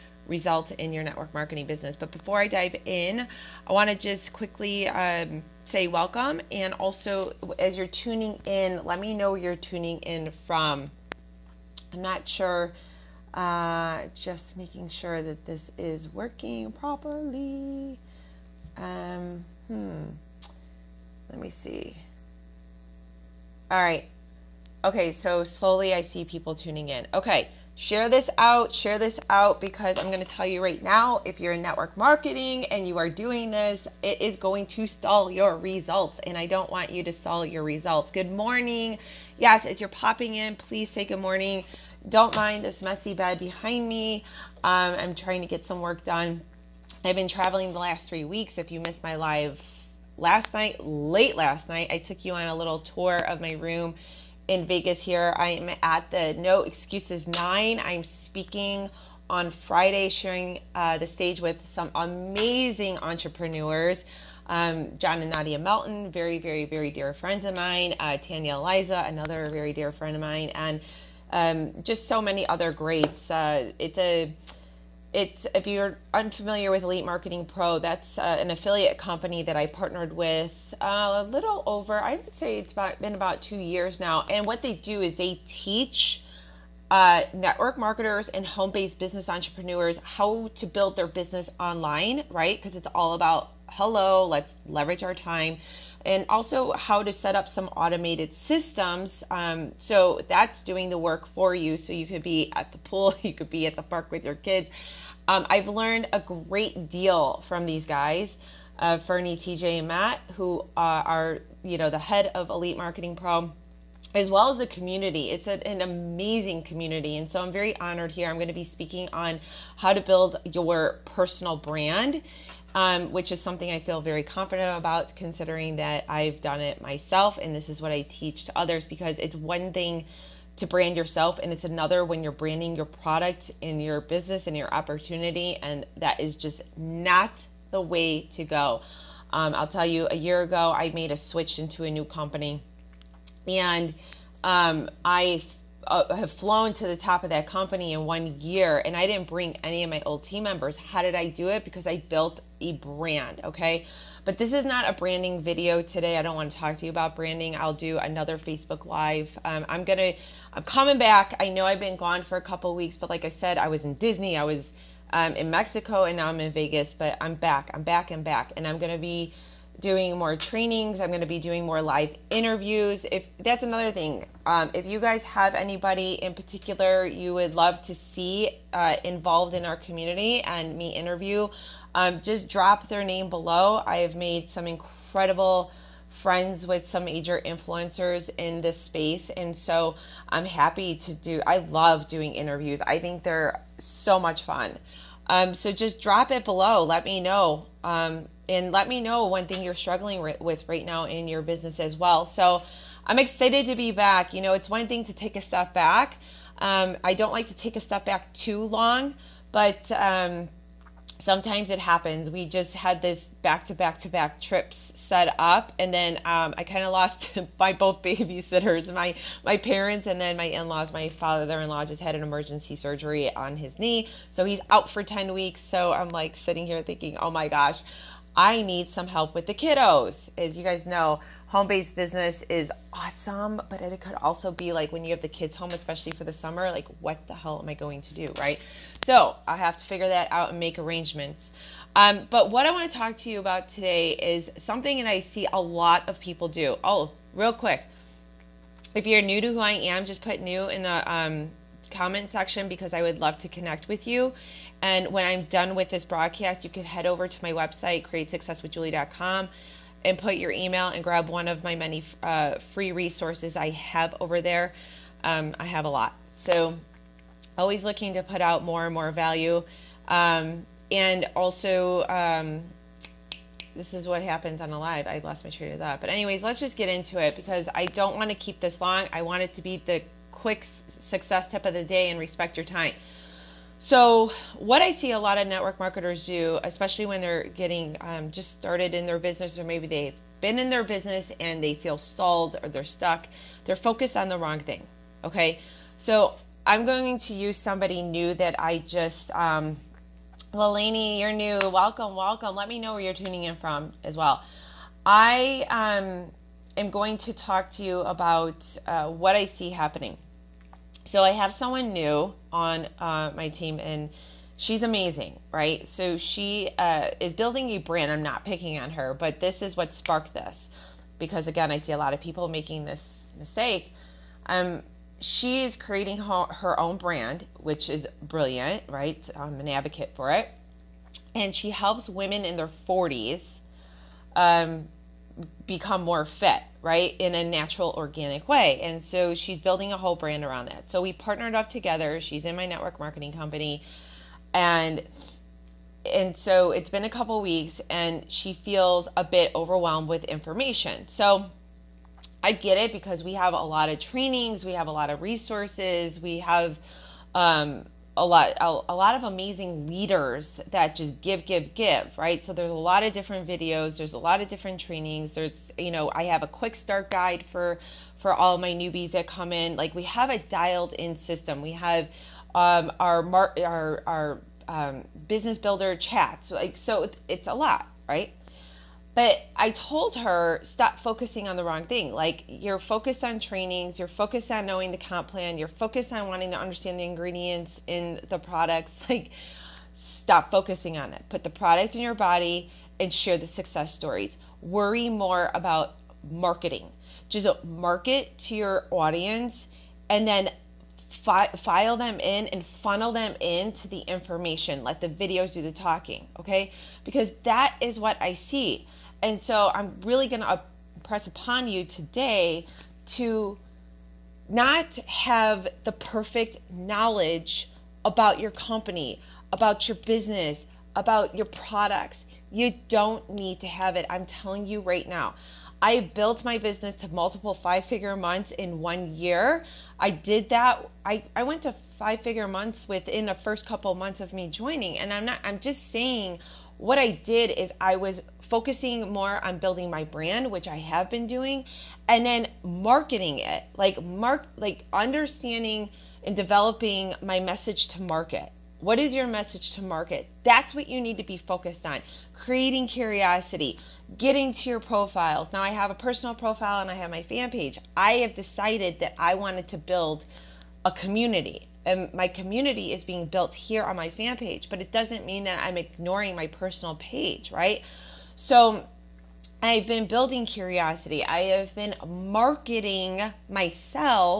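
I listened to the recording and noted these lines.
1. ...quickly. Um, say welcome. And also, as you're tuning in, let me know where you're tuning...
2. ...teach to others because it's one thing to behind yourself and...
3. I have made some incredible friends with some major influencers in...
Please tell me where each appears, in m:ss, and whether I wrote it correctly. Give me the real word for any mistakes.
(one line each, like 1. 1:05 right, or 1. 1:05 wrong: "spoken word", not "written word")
1. 0:04 right
2. 2:08 wrong: "brand", not "behind"
3. 3:03 right.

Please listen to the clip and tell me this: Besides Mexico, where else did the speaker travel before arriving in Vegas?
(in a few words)
Disney.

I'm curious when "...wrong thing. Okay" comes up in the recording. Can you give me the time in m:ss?
4:54.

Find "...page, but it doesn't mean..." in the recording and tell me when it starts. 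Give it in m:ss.
7:44.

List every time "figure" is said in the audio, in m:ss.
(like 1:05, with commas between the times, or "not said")
3:59, 7:07, 7:12.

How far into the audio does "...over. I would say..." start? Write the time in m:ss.
1:21.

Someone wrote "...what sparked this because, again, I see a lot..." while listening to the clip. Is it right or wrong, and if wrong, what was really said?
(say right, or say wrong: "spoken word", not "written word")
right.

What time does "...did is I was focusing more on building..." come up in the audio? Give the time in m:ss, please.
7:17.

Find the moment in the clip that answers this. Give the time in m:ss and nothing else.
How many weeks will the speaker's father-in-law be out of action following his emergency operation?
3:45.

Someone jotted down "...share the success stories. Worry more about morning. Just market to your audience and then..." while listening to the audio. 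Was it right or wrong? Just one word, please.
wrong.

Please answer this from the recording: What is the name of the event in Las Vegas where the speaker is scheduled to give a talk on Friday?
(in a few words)
No Excuses 9.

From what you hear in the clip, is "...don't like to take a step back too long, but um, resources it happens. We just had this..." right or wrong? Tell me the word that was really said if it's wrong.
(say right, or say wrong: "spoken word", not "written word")
wrong: "sometimes", not "resources".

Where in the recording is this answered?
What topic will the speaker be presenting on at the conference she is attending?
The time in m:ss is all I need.
2:01.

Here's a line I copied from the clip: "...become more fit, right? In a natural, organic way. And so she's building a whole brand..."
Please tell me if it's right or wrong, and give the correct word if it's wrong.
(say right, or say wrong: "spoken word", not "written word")
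right.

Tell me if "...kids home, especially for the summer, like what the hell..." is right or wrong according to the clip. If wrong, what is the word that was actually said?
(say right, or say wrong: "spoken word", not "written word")
right.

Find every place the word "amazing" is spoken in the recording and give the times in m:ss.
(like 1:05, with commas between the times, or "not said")
1:01, 1:55, 5:14, 5:59.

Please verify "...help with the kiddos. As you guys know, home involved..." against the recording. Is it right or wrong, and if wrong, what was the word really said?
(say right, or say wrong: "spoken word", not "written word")
wrong: "based", not "involved".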